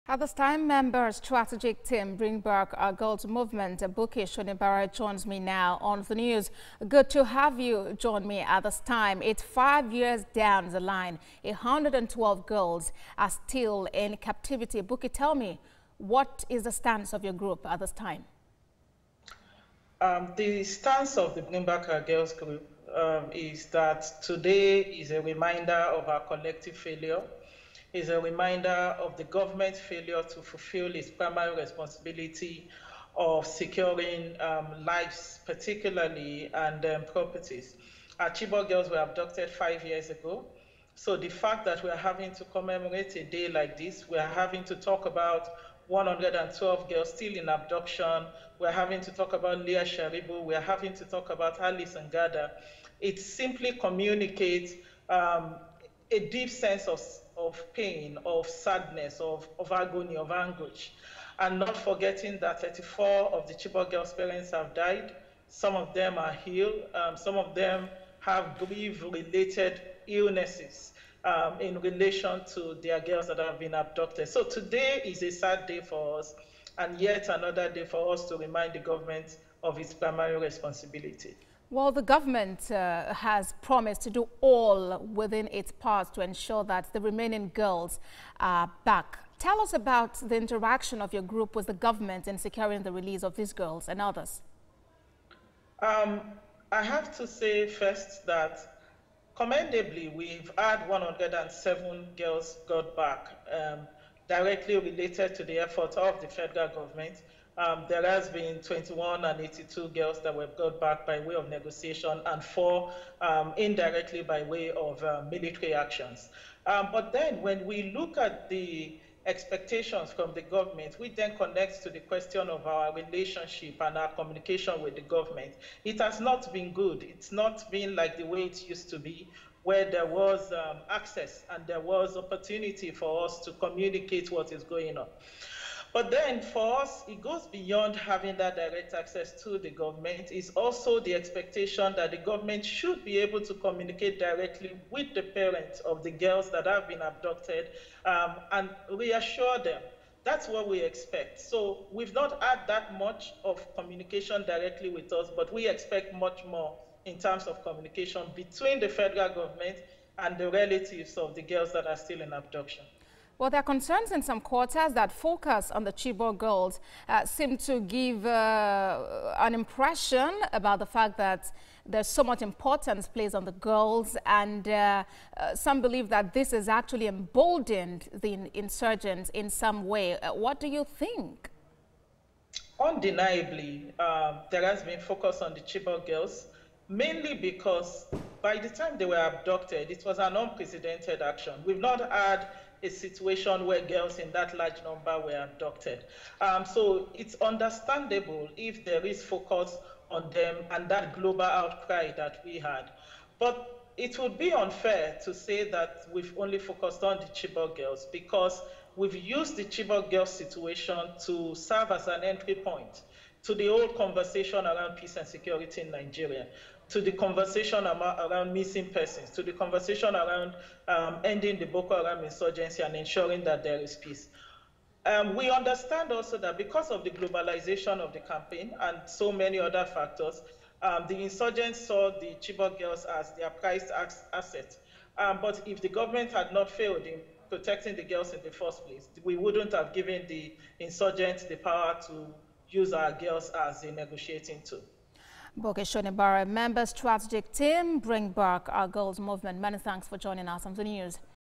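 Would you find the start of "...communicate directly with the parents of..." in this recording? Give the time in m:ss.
2:23.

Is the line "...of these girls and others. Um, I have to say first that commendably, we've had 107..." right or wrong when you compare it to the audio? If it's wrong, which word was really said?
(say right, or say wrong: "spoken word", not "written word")
right.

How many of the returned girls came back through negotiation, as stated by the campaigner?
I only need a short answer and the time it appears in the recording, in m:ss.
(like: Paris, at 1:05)
82, at 1:49.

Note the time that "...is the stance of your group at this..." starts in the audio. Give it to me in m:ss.
0:16.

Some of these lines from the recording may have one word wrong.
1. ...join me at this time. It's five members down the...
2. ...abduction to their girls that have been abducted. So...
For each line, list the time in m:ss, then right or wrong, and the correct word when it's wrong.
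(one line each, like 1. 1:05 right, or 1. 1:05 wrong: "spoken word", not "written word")
1. 0:07 wrong: "years", not "members"
2. 1:11 wrong: "relation", not "abduction".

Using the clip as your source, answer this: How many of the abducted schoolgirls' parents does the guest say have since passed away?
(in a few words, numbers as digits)
34.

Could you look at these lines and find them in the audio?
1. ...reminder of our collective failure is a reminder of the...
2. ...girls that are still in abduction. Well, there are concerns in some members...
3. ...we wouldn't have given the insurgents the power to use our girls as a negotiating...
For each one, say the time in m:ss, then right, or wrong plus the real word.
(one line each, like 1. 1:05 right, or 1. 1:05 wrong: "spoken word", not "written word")
1. 0:25 right
2. 2:41 wrong: "quarters", not "members"
3. 3:59 right.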